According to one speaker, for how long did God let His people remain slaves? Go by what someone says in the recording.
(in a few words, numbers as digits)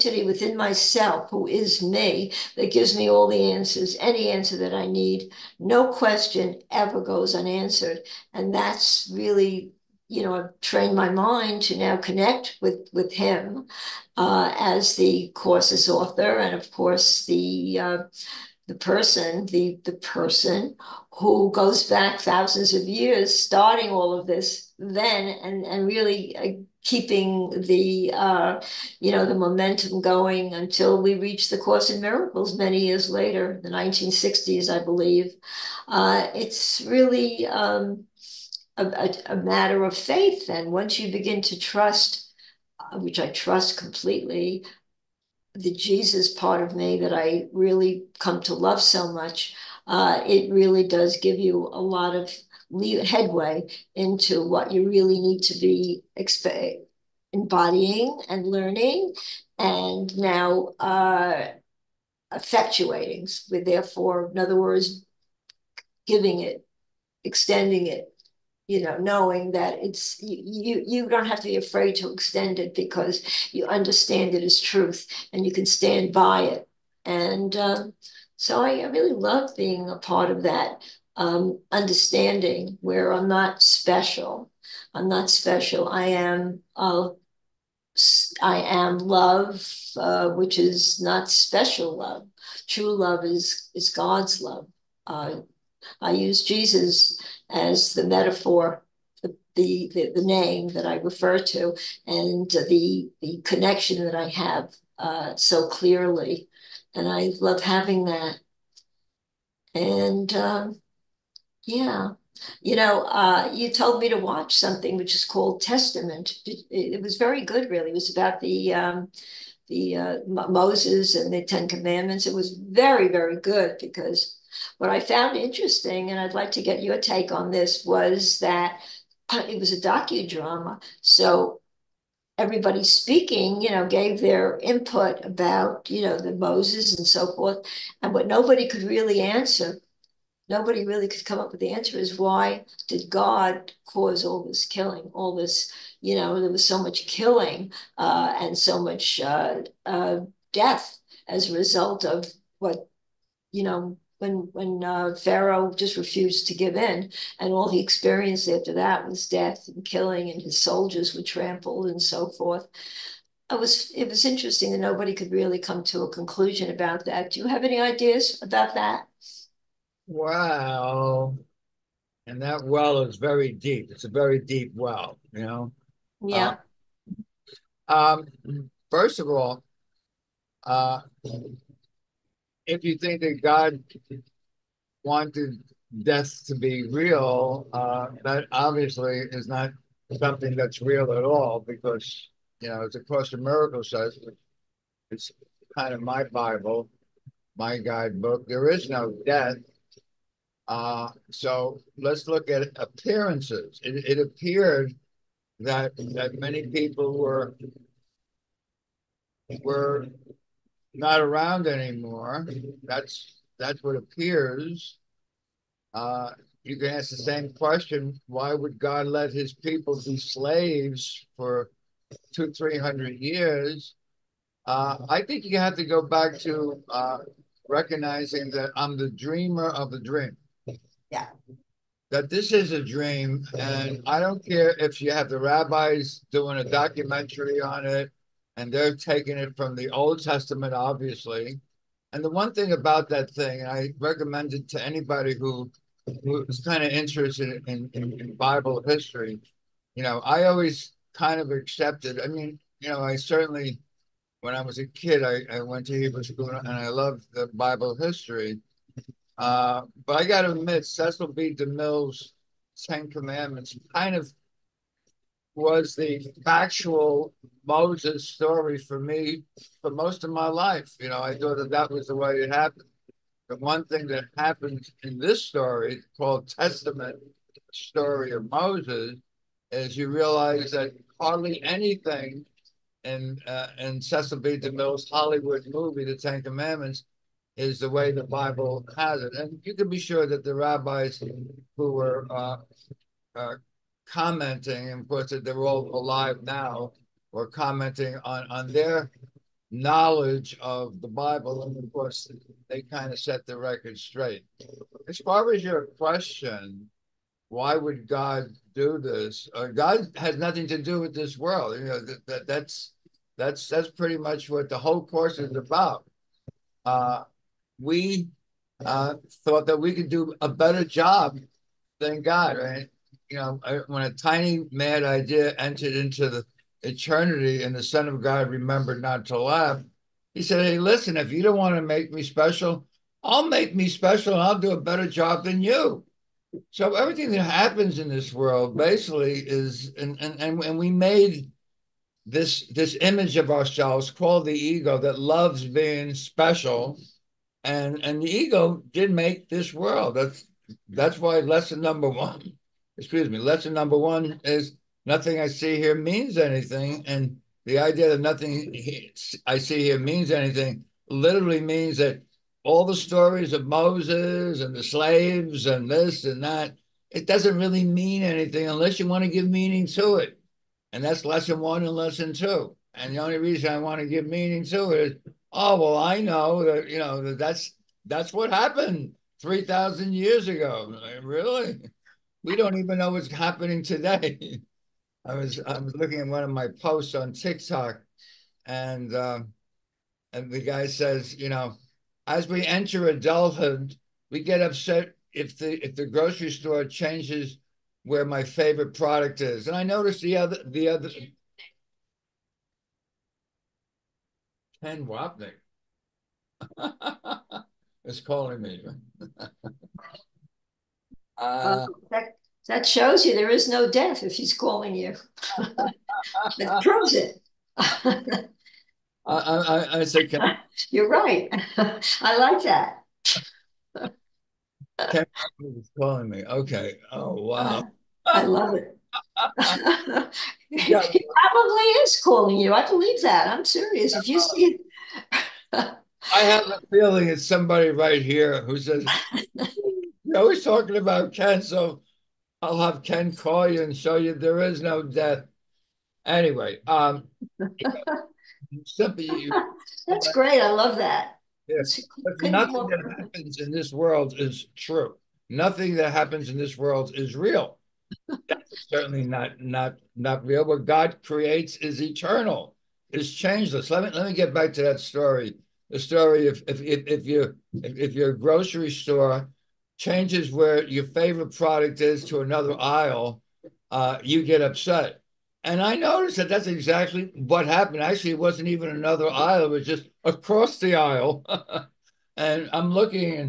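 200 to 300 years.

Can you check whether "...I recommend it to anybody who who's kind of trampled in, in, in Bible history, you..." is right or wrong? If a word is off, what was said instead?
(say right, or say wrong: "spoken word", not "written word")
wrong: "interested", not "trampled".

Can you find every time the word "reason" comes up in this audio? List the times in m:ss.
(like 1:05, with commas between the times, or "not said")
6:13.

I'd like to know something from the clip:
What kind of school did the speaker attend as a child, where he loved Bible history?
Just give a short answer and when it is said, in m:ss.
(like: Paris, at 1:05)
Hebrew school, at 4:16.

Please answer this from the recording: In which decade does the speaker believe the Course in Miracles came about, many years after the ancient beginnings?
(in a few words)
1960s.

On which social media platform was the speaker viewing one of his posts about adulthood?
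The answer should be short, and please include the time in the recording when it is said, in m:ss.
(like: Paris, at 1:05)
TikTok, at 6:27.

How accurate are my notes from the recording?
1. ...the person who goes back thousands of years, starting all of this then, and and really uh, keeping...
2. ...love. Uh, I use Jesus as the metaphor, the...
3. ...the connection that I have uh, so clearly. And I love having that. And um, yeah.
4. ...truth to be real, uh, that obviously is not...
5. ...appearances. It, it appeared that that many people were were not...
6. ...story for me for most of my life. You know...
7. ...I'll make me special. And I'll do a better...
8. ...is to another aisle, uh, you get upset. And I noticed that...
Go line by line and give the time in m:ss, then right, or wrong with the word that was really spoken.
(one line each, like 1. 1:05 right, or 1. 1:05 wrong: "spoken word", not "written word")
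1. 0:19 right
2. 1:34 right
3. 1:43 right
4. 3:06 wrong: "death", not "truth"
5. 3:22 right
6. 4:28 right
7. 5:33 right
8. 7:52 right.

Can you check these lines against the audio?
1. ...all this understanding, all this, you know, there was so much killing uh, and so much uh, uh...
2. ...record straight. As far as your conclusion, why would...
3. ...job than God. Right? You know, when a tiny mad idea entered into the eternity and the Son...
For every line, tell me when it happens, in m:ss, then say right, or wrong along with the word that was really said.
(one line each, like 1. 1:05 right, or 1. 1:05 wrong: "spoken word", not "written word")
1. 2:24 wrong: "killing", not "understanding"
2. 5:03 wrong: "question", not "conclusion"
3. 5:20 right.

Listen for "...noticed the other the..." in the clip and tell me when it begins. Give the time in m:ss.
6:39.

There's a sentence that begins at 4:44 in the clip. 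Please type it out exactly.
DeMille's Hollywood movie, The Ten Commandments, is the way the Bible has it.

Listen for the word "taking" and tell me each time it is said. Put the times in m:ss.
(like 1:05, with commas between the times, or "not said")
3:58.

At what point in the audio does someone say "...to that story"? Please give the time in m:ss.
7:44.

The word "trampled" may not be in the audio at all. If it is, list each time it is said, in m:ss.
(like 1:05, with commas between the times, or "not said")
2:41.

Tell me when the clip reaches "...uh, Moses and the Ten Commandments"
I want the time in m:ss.
1:59.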